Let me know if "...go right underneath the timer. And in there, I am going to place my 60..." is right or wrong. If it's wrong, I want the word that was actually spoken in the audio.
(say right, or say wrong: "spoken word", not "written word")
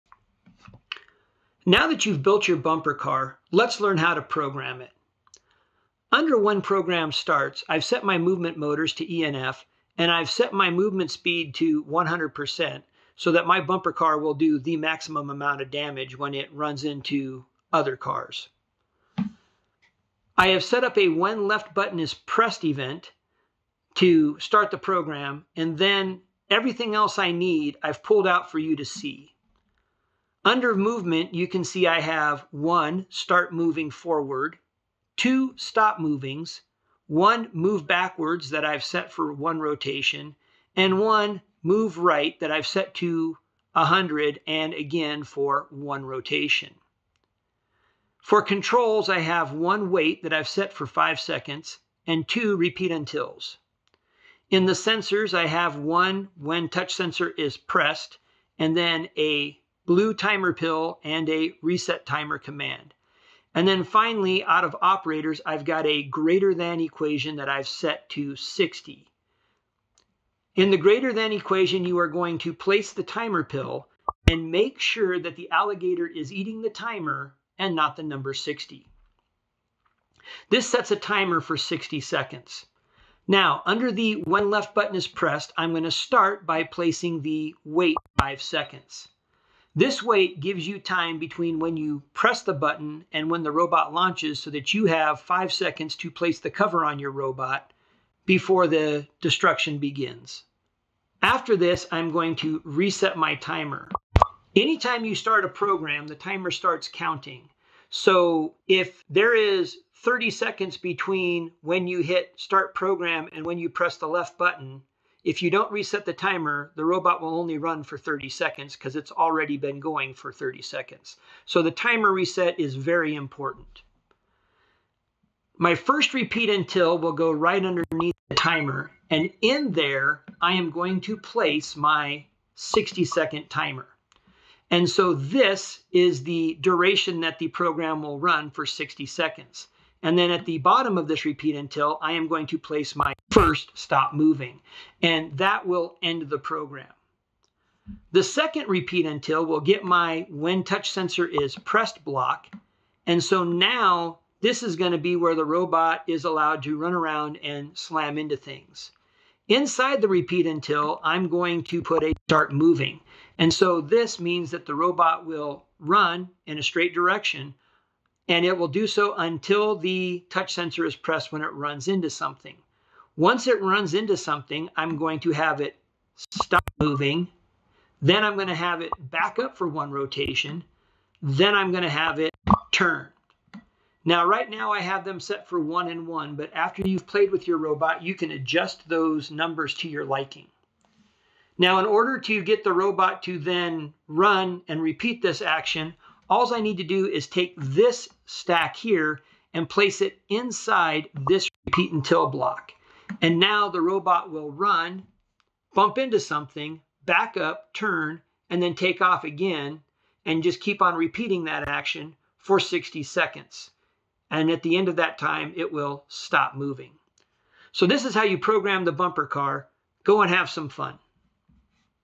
right.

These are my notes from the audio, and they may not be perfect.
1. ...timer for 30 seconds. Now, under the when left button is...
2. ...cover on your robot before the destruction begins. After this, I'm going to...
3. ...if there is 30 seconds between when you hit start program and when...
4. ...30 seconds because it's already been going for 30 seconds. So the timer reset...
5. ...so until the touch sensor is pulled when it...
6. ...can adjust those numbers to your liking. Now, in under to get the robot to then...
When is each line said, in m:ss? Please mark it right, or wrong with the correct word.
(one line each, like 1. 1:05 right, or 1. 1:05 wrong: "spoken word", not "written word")
1. 1:20 wrong: "60", not "30"
2. 1:36 right
3. 1:48 right
4. 1:57 right
5. 2:48 wrong: "pressed", not "pulled"
6. 3:08 wrong: "order", not "under".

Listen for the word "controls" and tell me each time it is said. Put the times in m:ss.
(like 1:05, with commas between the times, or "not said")
0:48.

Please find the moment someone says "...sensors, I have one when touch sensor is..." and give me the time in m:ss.
0:54.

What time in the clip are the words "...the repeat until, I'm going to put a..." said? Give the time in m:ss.
2:40.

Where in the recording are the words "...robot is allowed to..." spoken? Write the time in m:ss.
2:35.